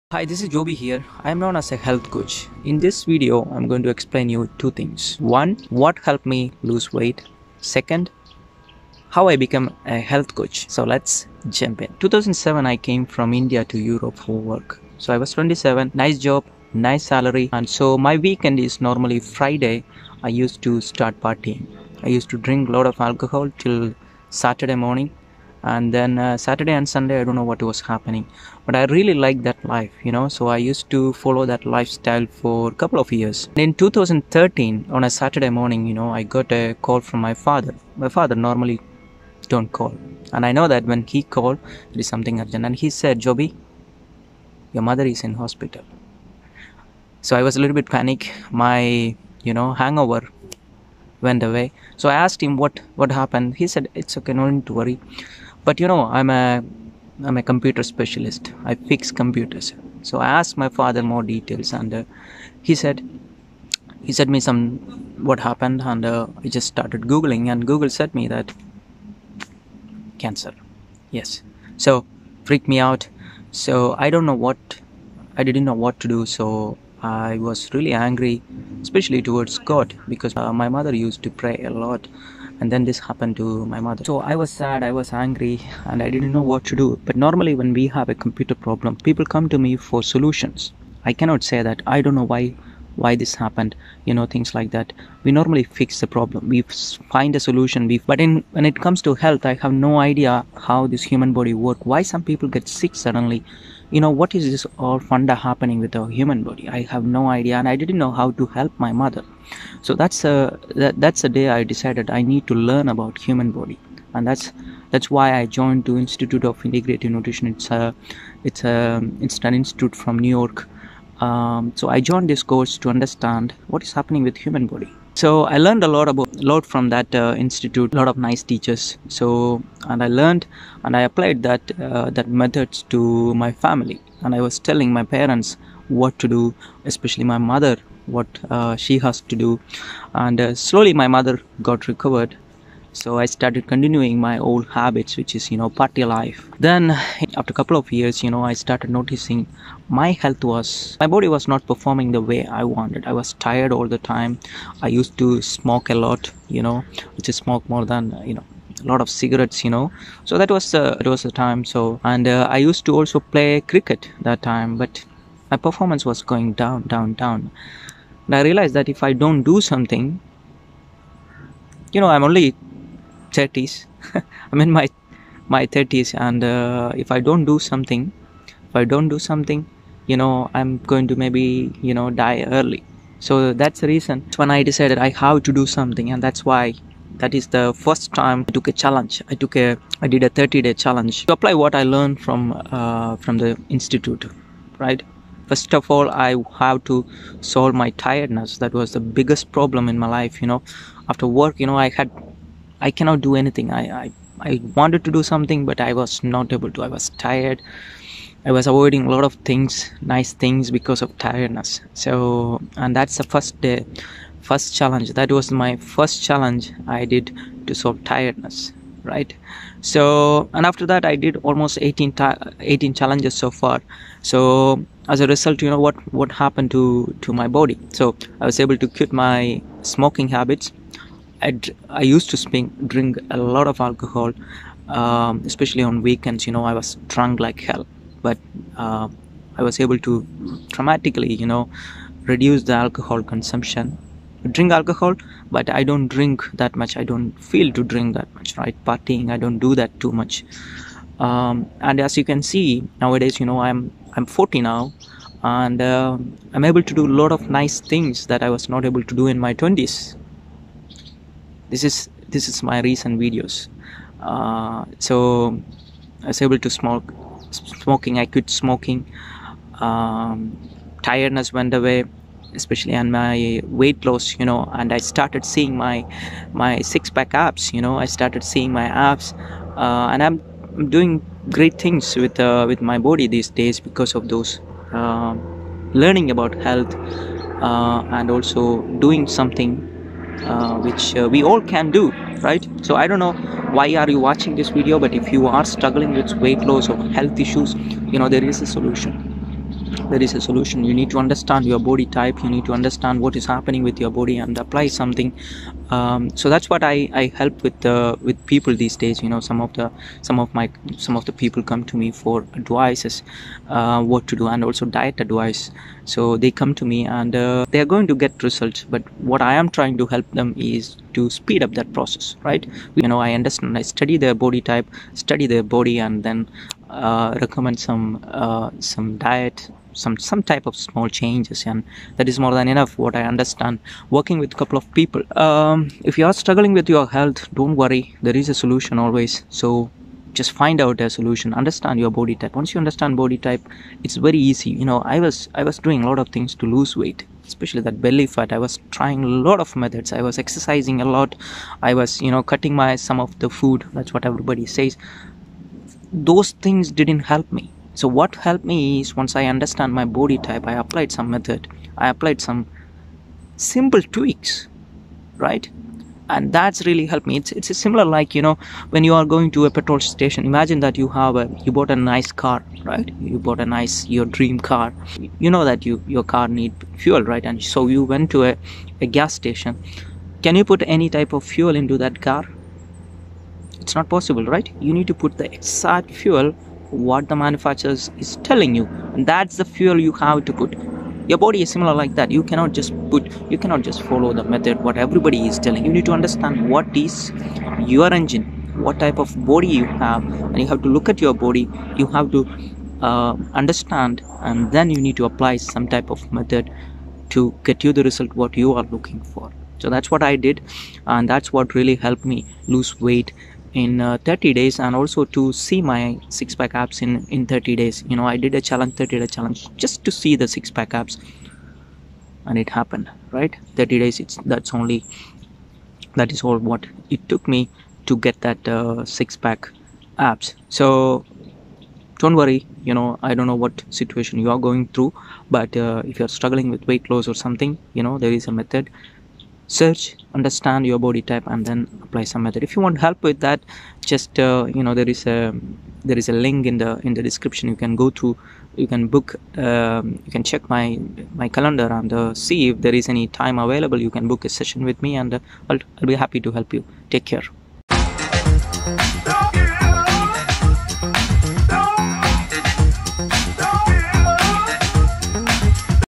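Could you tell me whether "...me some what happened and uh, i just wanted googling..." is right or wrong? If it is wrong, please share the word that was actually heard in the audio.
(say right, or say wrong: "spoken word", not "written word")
wrong: "started", not "wanted".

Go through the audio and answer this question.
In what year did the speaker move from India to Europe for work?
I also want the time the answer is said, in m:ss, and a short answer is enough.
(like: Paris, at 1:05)
2007, at 0:12.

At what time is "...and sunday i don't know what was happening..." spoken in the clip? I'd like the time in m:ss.
0:26.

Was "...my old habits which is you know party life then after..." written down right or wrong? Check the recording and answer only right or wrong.
right.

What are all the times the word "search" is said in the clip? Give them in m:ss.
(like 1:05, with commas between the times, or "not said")
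7:19.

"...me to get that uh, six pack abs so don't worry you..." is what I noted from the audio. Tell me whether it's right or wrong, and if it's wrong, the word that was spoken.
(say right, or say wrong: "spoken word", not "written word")
right.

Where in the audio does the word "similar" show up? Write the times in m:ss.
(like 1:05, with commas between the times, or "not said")
6:07, 6:31.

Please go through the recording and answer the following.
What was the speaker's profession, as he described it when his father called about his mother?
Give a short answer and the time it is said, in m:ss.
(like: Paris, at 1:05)
Computer specialist, at 0:57.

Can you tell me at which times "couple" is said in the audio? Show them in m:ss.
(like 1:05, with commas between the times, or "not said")
0:32, 2:27, 5:34.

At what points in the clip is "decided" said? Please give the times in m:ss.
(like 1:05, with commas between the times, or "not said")
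1:51, 3:04.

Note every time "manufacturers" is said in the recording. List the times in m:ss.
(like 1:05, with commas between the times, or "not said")
6:27.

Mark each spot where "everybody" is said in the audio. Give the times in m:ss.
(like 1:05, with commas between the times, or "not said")
5:54, 6:34.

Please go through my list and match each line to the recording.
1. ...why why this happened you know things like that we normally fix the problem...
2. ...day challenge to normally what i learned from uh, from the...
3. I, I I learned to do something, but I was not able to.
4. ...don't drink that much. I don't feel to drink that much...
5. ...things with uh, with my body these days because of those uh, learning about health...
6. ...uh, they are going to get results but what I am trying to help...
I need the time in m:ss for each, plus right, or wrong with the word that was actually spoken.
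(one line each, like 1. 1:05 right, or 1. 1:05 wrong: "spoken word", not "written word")
1. 1:32 right
2. 3:10 wrong: "apply", not "normally"
3. 3:23 wrong: "wanted", not "learned"
4. 4:05 right
5. 4:41 right
6. 5:17 right.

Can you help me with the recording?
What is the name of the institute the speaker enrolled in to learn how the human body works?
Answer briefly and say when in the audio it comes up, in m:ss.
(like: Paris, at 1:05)
Institute of Integrative Nutrition, at 1:55.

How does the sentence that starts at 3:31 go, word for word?
So, and that's the first day, first challenge.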